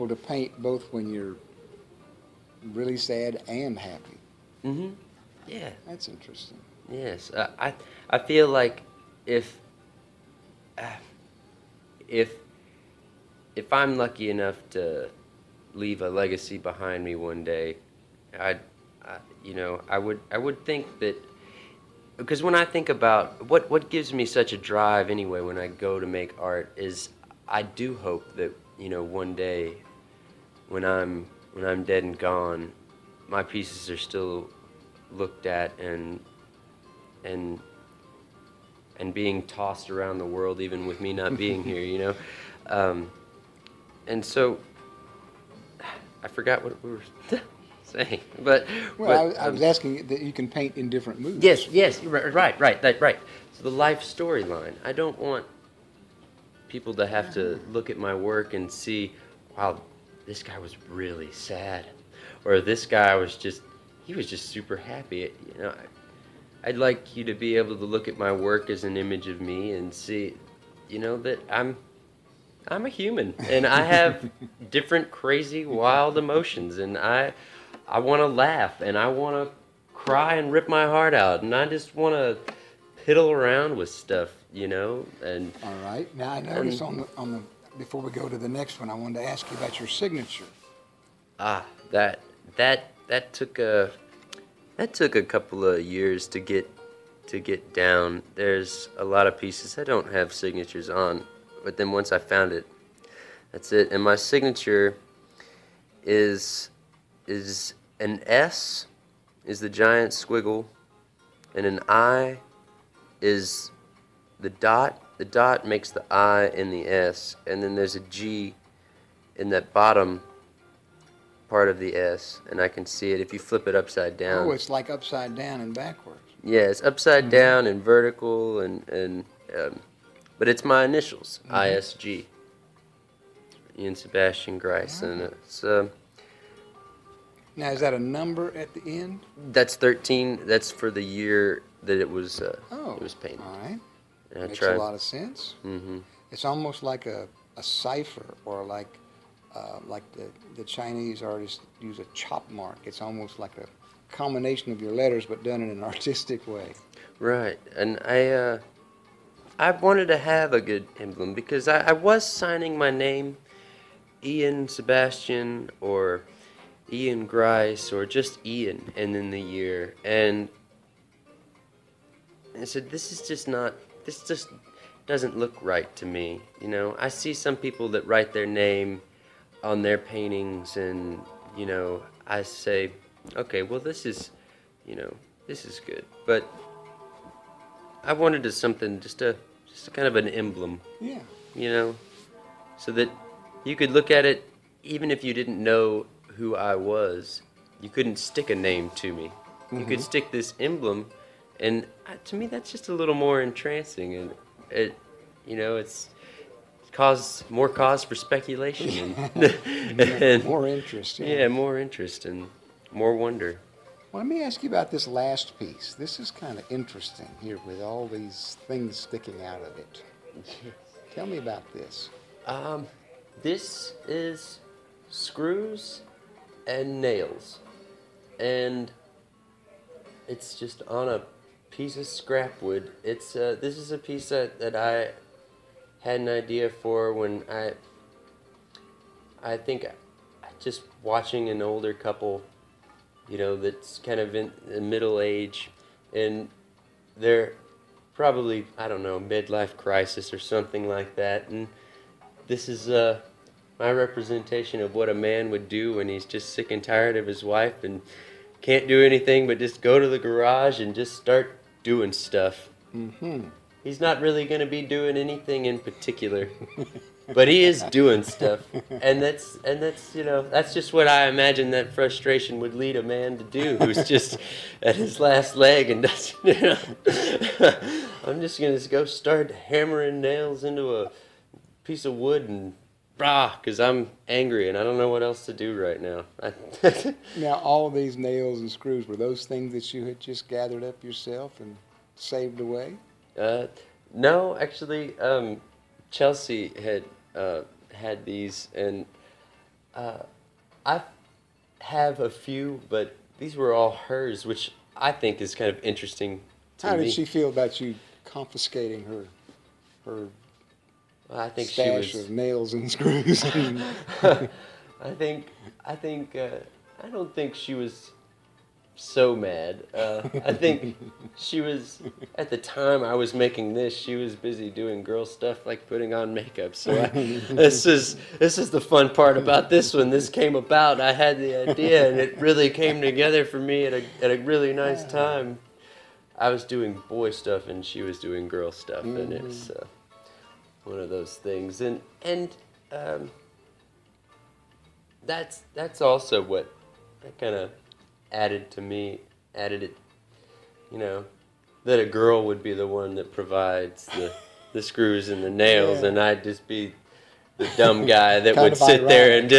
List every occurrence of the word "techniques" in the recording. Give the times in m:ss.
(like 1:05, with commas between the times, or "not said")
not said.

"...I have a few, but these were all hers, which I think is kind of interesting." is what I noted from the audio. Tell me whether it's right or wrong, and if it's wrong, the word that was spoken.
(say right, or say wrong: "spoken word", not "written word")
right.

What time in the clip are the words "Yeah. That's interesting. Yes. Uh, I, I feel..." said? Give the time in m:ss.
0:05.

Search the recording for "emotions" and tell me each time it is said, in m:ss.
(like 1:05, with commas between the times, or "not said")
1:16.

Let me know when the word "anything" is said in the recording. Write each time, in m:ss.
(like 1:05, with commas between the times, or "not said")
4:19, 4:25.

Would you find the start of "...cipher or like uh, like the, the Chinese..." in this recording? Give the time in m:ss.
2:27.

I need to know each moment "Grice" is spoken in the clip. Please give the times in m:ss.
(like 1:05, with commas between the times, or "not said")
2:14, 2:47.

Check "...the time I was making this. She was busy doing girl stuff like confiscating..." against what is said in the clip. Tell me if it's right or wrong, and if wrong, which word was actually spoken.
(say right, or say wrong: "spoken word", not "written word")
wrong: "putting", not "confiscating".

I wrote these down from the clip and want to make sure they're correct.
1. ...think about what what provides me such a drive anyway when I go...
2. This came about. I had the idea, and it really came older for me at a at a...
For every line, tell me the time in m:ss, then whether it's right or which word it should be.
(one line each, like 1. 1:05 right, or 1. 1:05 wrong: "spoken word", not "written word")
1. 0:22 wrong: "gives", not "provides"
2. 5:30 wrong: "together", not "older".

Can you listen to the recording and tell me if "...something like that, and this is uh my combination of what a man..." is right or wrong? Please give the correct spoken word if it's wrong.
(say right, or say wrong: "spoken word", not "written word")
wrong: "representation", not "combination".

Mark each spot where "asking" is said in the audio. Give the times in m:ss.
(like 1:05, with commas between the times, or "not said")
0:49.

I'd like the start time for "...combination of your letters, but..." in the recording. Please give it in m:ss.
2:34.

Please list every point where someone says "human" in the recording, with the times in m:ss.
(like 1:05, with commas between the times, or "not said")
1:12.